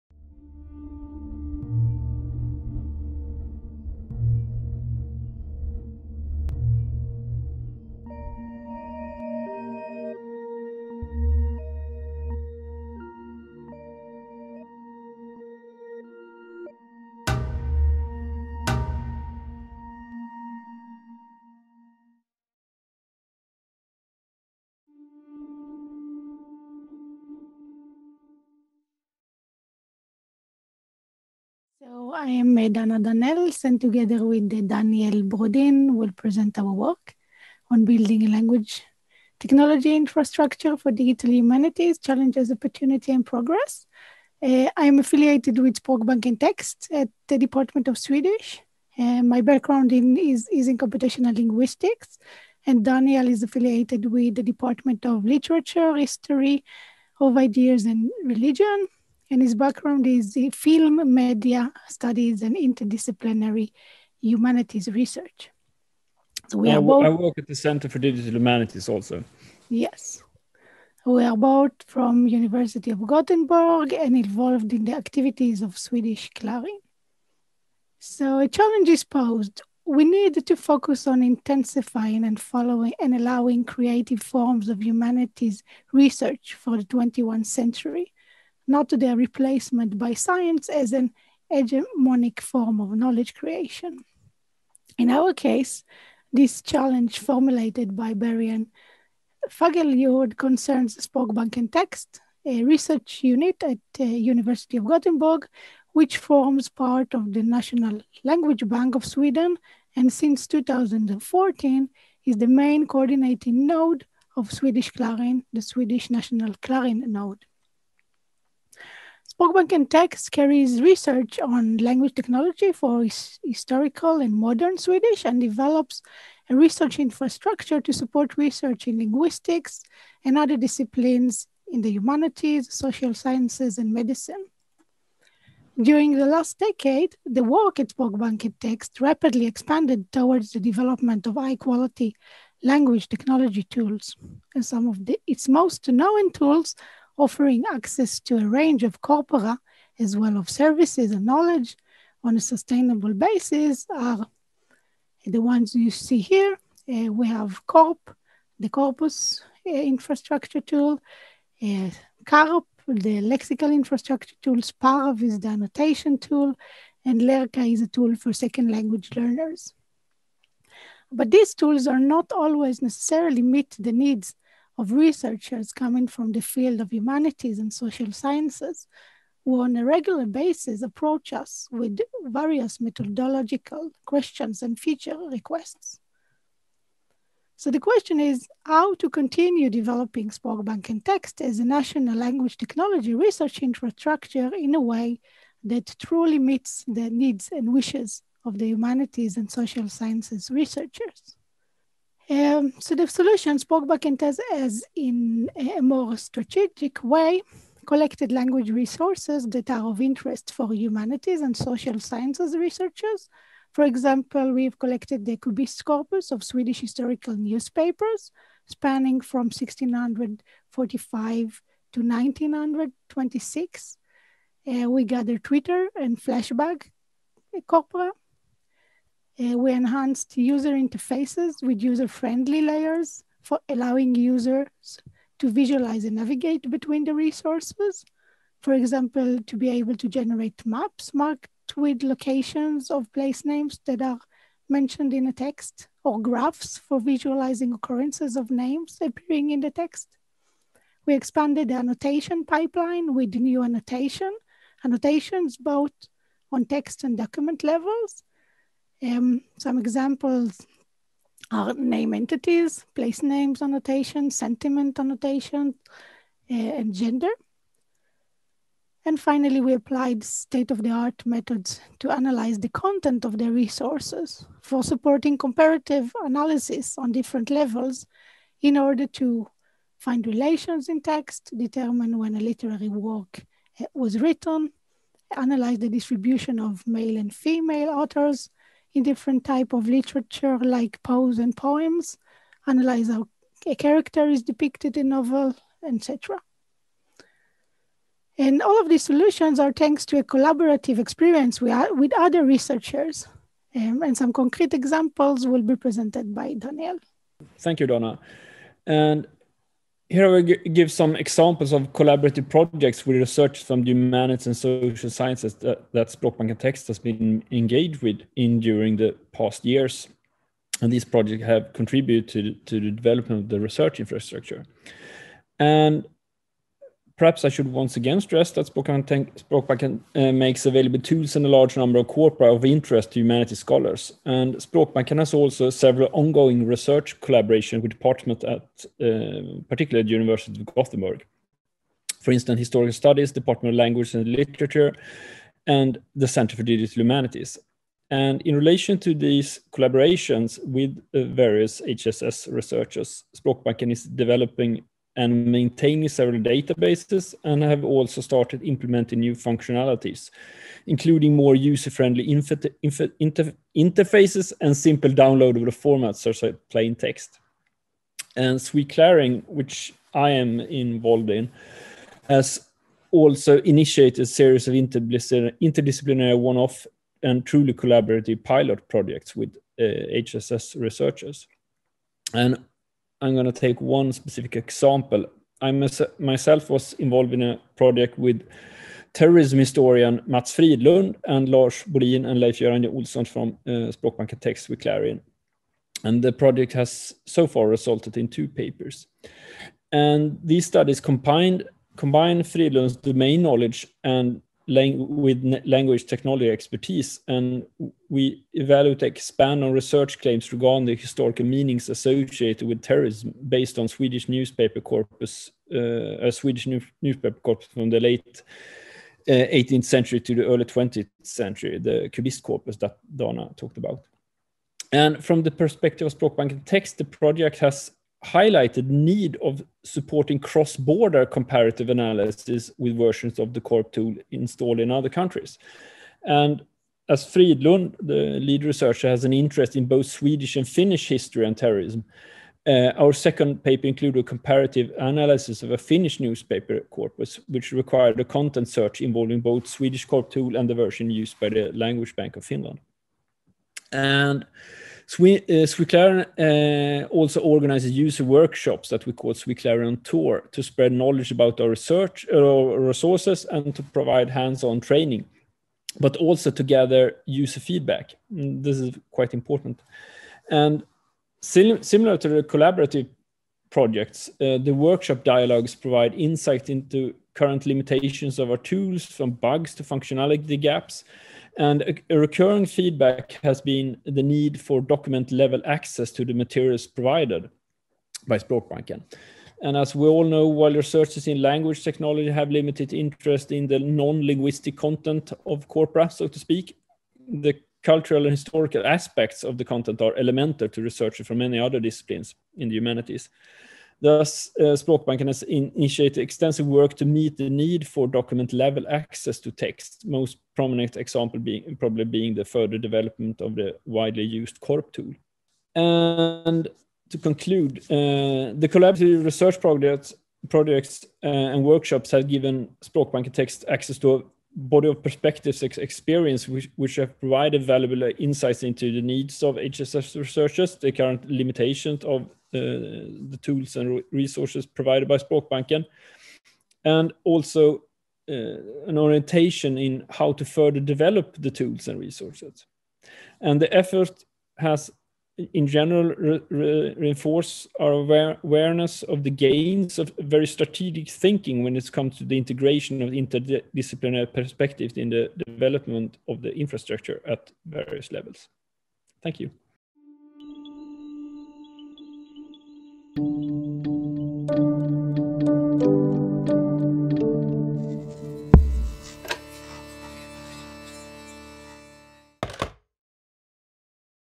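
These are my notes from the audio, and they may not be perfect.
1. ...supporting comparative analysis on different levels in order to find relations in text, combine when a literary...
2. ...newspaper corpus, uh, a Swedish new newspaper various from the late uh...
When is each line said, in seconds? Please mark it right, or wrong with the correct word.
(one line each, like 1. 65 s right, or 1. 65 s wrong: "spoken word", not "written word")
1. 274 s wrong: "determine", not "combine"
2. 414 s wrong: "corpus", not "various".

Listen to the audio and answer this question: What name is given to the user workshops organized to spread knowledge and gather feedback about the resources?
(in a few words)
Swe-Clarin Tour.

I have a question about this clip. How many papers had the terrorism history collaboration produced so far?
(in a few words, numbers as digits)
2.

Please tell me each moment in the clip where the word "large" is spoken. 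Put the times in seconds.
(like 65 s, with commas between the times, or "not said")
331 s.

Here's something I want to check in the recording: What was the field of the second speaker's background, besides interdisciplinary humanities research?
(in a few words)
film media studies.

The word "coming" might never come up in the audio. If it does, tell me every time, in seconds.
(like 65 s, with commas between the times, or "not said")
175 s.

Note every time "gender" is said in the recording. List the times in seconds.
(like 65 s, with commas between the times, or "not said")
266 s.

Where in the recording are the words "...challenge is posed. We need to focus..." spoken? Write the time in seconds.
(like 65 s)
78 s.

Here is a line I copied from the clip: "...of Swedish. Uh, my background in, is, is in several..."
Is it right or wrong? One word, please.
wrong.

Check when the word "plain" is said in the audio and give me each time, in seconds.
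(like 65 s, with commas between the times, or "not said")
366 s.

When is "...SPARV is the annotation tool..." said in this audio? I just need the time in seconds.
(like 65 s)
164 s.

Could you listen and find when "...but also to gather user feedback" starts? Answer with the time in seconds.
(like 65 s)
465 s.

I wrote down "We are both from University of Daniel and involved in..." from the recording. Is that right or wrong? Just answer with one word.
wrong.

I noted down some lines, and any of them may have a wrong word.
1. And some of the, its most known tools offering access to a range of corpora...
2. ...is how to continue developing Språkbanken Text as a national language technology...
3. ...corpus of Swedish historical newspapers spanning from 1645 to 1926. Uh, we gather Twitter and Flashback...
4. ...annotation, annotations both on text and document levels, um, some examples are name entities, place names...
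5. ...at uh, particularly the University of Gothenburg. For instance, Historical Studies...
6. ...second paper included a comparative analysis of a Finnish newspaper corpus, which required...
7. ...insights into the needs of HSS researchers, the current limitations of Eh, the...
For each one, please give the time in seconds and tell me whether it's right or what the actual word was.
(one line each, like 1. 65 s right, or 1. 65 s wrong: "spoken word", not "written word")
1. 144 s right
2. 188 s right
3. 215 s right
4. 253 s right
5. 338 s right
6. 443 s right
7. 528 s right.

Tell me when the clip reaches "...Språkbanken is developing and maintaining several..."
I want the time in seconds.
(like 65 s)
353 s.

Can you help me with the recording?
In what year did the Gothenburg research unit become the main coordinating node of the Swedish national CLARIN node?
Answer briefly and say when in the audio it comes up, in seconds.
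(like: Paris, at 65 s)
2014, at 110 s.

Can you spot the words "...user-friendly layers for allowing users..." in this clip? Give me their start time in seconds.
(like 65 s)
231 s.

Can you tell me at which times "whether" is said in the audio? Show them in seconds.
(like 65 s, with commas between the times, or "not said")
not said.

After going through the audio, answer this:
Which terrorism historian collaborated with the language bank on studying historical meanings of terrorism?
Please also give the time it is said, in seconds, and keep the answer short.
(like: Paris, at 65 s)
Mats Fridlund, at 390 s.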